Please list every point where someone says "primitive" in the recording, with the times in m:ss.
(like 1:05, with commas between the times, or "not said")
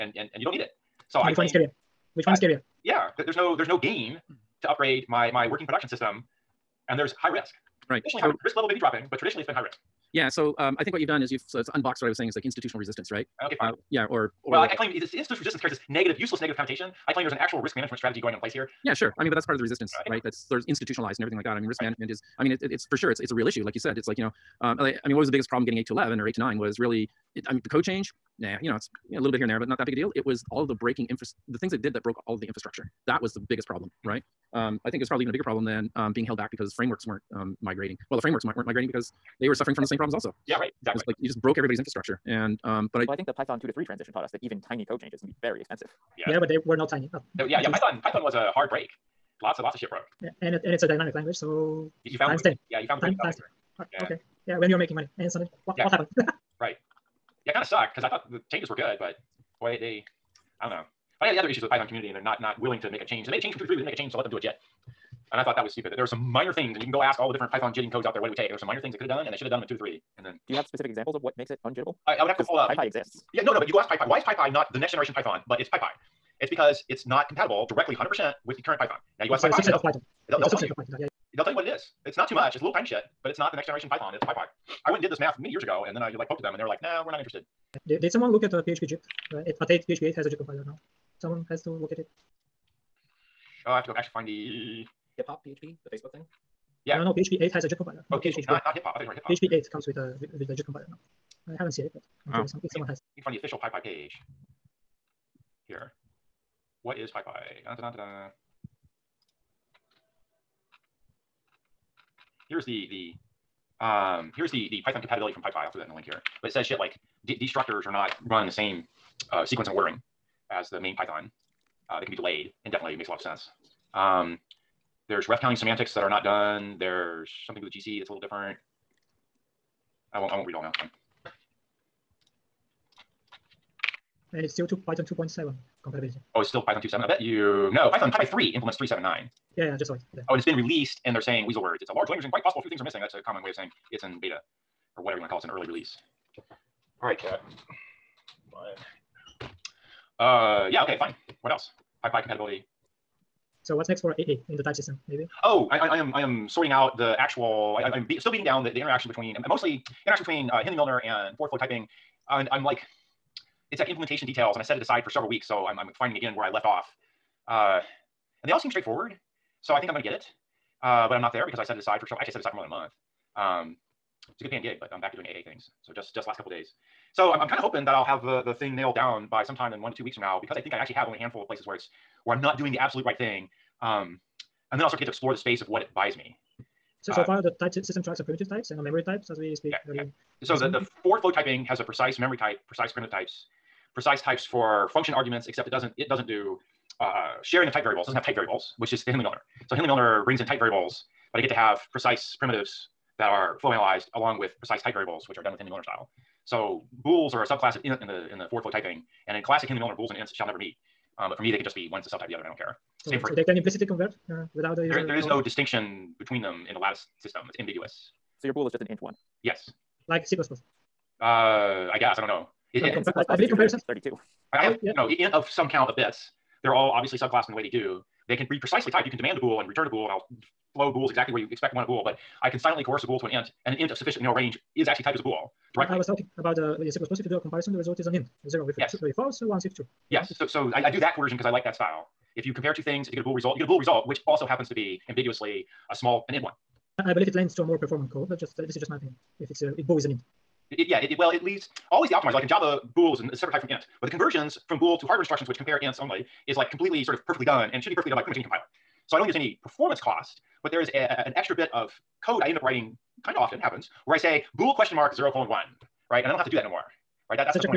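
3:08, 3:12, 3:22.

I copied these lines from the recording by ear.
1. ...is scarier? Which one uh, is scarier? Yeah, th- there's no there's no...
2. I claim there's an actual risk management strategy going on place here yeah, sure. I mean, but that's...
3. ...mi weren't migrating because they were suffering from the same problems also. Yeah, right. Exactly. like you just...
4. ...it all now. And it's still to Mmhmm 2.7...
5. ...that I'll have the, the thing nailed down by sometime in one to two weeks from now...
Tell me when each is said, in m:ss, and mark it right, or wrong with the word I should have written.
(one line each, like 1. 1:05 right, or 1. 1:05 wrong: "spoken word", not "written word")
1. 0:01 right
2. 0:17 right
3. 0:38 right
4. 2:10 wrong: "Python", not "Mmhmm"
5. 2:57 right.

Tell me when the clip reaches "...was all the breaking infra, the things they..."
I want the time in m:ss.
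0:30.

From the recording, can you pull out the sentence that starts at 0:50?
Yeah, and it and it's a dynamic language, so you, you found times ten.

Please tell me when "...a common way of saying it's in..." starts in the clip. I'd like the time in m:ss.
2:23.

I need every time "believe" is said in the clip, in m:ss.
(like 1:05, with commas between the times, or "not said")
3:43, 4:07.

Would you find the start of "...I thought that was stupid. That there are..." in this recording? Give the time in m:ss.
1:05.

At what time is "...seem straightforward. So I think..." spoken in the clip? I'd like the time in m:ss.
2:48.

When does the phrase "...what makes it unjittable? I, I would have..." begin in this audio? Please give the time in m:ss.
1:11.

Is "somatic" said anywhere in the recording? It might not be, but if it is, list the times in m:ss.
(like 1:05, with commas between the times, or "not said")
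not said.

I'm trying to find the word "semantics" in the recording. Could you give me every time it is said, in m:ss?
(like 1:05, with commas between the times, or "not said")
2:05.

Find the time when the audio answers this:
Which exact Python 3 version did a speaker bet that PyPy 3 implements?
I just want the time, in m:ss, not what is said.
2:18.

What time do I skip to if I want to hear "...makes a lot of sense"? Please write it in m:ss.
2:02.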